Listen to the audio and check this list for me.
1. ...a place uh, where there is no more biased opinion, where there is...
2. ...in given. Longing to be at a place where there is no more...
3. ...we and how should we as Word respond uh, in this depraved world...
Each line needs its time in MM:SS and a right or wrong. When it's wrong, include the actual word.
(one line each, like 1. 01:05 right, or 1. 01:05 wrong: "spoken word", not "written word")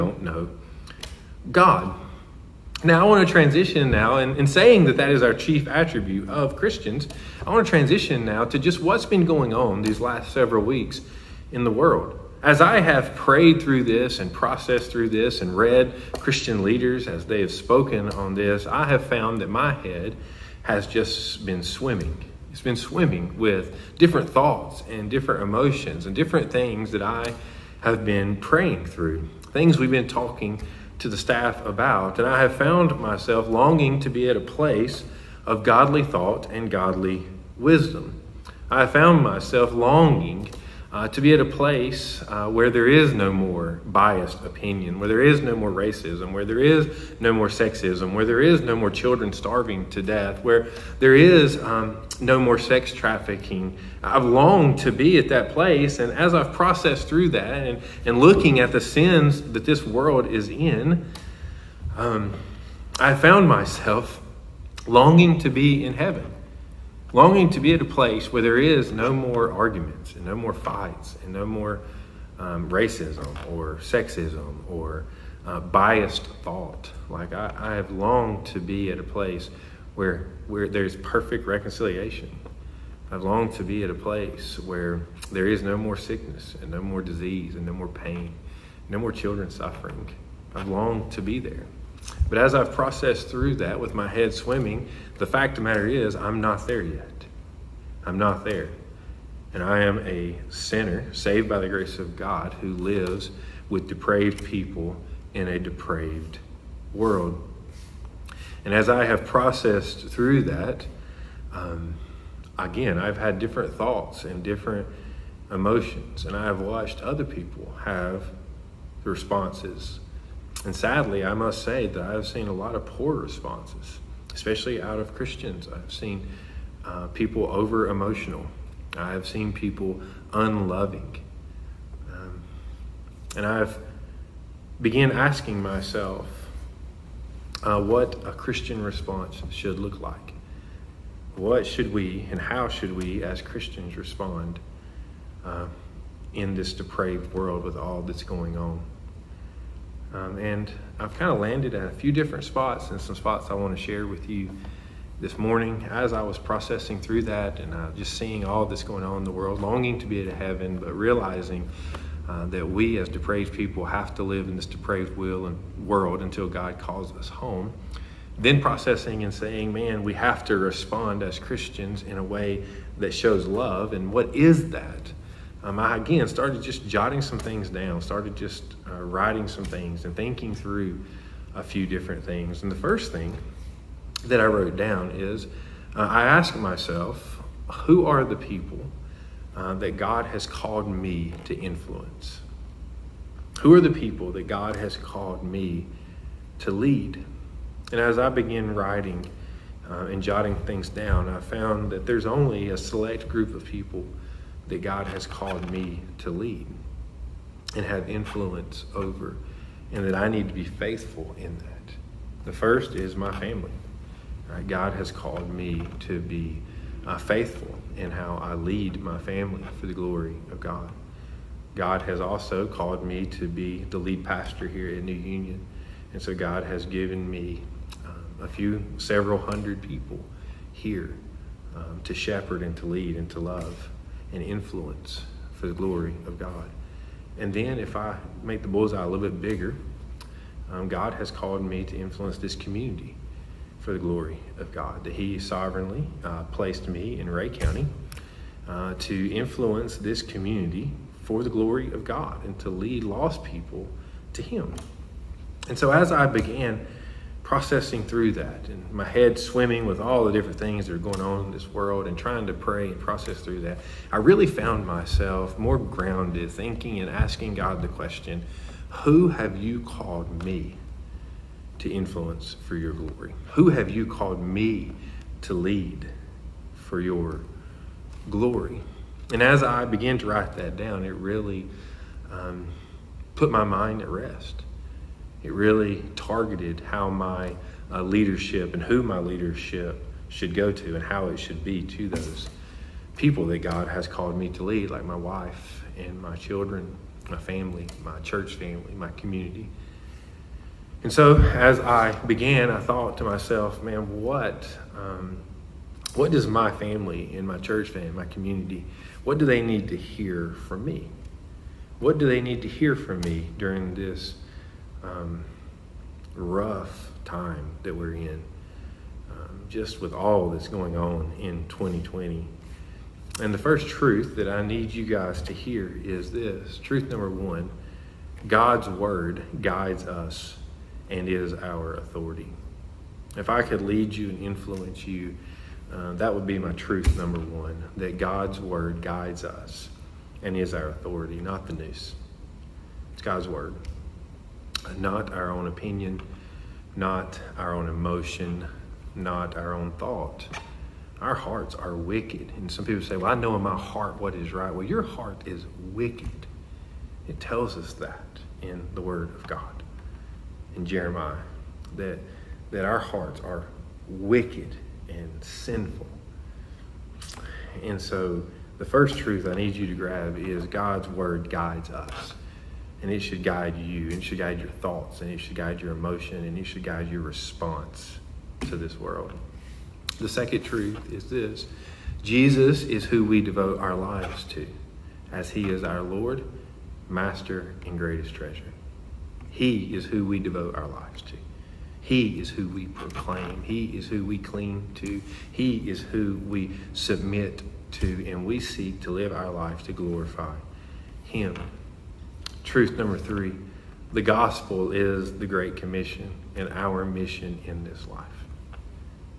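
1. 00:41 right
2. 01:05 wrong: "heaven", not "given"
3. 02:21 wrong: "Christians", not "Word".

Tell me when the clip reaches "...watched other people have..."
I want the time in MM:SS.
01:56.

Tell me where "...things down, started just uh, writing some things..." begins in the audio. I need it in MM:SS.
02:57.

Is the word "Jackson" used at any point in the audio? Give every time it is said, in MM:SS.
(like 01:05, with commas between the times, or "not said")
not said.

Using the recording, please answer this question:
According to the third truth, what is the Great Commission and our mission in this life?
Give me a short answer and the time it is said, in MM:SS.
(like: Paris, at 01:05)
the gospel, at 06:44.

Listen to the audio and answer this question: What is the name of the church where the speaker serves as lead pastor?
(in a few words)
New Union.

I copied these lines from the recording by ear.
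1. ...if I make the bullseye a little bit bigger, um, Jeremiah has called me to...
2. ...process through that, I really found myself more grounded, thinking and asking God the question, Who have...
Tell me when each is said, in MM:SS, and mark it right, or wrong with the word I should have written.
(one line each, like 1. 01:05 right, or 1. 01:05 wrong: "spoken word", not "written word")
1. 03:57 wrong: "God", not "Jeremiah"
2. 04:22 right.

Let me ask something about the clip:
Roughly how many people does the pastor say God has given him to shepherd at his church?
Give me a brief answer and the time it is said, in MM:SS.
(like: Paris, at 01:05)
several hundred, at 03:48.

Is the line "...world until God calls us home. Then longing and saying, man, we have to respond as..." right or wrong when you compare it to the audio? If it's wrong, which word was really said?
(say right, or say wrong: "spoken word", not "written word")
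wrong: "processing", not "longing".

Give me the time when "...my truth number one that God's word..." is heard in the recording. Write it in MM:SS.
05:36.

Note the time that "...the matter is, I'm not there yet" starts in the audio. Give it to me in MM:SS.
01:35.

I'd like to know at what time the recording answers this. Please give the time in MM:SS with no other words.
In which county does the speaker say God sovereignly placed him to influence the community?
04:07.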